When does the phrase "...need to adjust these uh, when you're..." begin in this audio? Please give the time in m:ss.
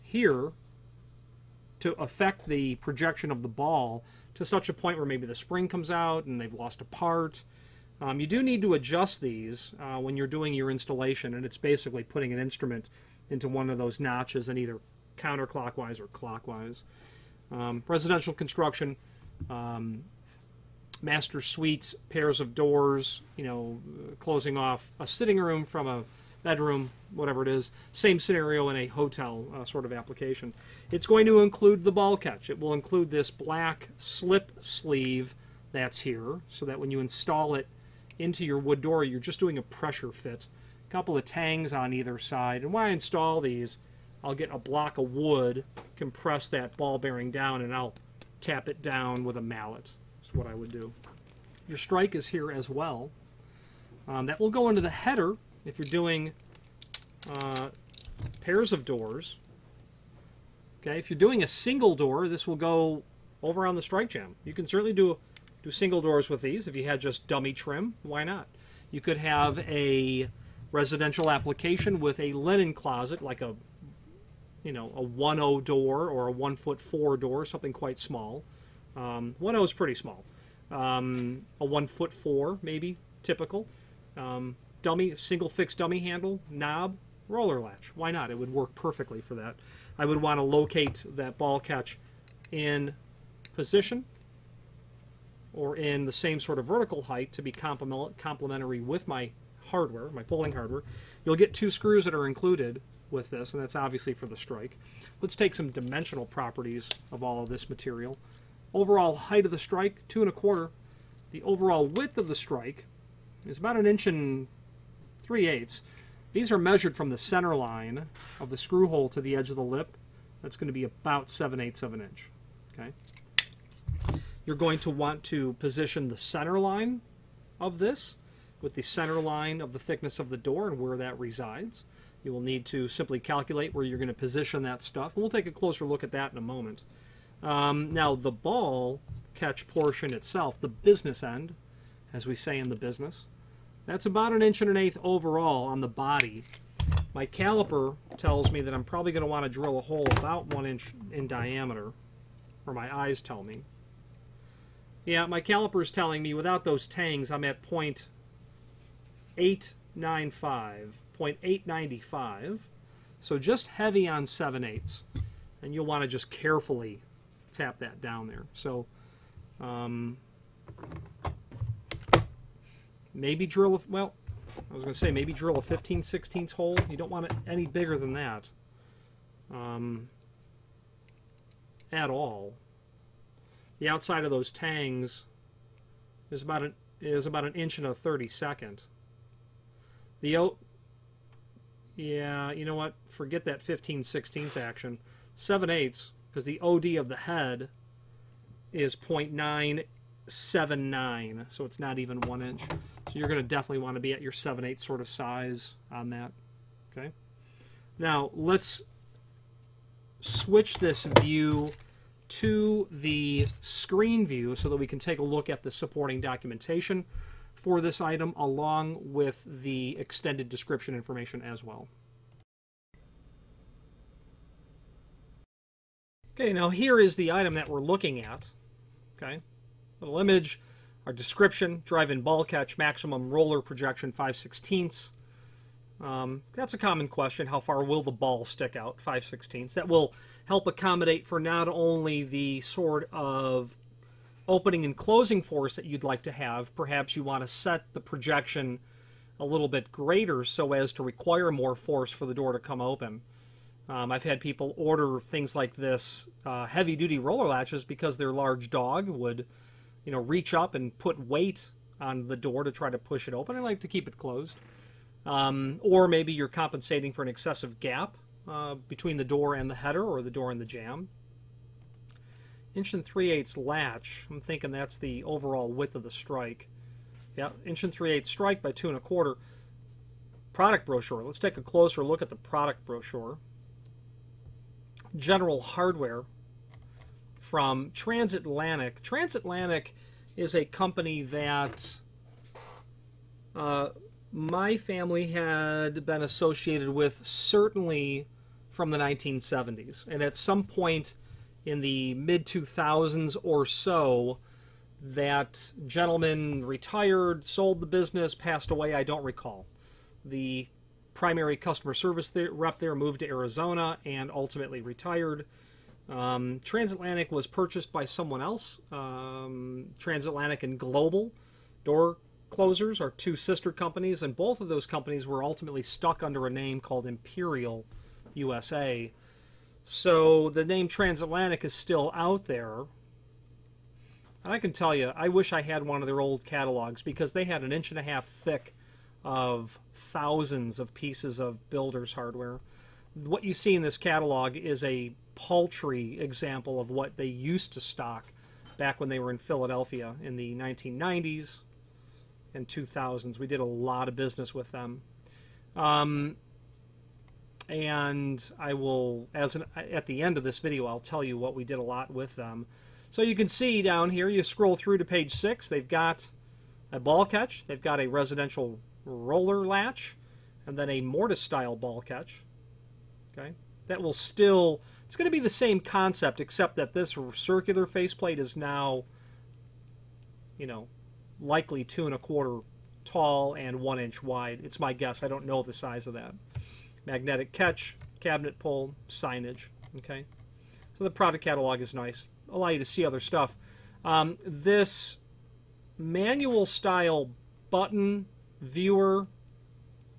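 0:08.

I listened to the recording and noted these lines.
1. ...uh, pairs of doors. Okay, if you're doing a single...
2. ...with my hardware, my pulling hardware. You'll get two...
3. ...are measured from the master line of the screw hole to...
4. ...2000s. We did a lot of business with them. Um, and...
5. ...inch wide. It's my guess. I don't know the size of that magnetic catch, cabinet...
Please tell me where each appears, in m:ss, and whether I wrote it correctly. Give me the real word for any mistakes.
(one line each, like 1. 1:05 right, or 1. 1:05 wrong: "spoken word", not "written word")
1. 0:57 right
2. 1:38 right
3. 1:56 wrong: "center", not "master"
4. 5:52 right
5. 6:23 right.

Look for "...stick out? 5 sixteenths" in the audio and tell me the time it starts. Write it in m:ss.
3:58.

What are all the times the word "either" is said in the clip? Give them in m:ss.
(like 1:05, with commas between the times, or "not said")
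0:14, 0:41.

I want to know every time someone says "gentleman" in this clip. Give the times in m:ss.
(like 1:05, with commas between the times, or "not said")
5:05.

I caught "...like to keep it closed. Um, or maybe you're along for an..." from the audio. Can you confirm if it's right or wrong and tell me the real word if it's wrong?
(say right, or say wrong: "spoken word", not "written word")
wrong: "compensating", not "along".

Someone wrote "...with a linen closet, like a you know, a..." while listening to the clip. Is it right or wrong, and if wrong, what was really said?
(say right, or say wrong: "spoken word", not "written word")
right.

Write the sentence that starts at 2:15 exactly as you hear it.
And we'll take a closer look at that in a moment.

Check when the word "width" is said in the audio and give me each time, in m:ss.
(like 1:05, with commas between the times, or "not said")
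1:51, 4:35.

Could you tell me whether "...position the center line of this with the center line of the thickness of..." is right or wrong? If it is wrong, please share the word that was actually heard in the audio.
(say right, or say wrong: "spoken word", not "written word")
right.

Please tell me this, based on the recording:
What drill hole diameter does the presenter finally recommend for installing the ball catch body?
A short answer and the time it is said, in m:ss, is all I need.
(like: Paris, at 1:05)
7/8 inch, at 3:24.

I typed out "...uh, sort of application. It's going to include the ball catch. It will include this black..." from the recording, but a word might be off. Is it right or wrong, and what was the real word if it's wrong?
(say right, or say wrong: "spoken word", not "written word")
right.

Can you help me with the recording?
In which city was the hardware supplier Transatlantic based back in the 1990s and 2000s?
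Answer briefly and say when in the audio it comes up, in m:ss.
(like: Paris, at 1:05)
Philadelphia, at 5:49.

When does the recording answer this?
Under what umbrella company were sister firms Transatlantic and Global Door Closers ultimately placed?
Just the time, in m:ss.
5:27.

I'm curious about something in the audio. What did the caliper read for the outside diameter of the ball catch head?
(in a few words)
0.979.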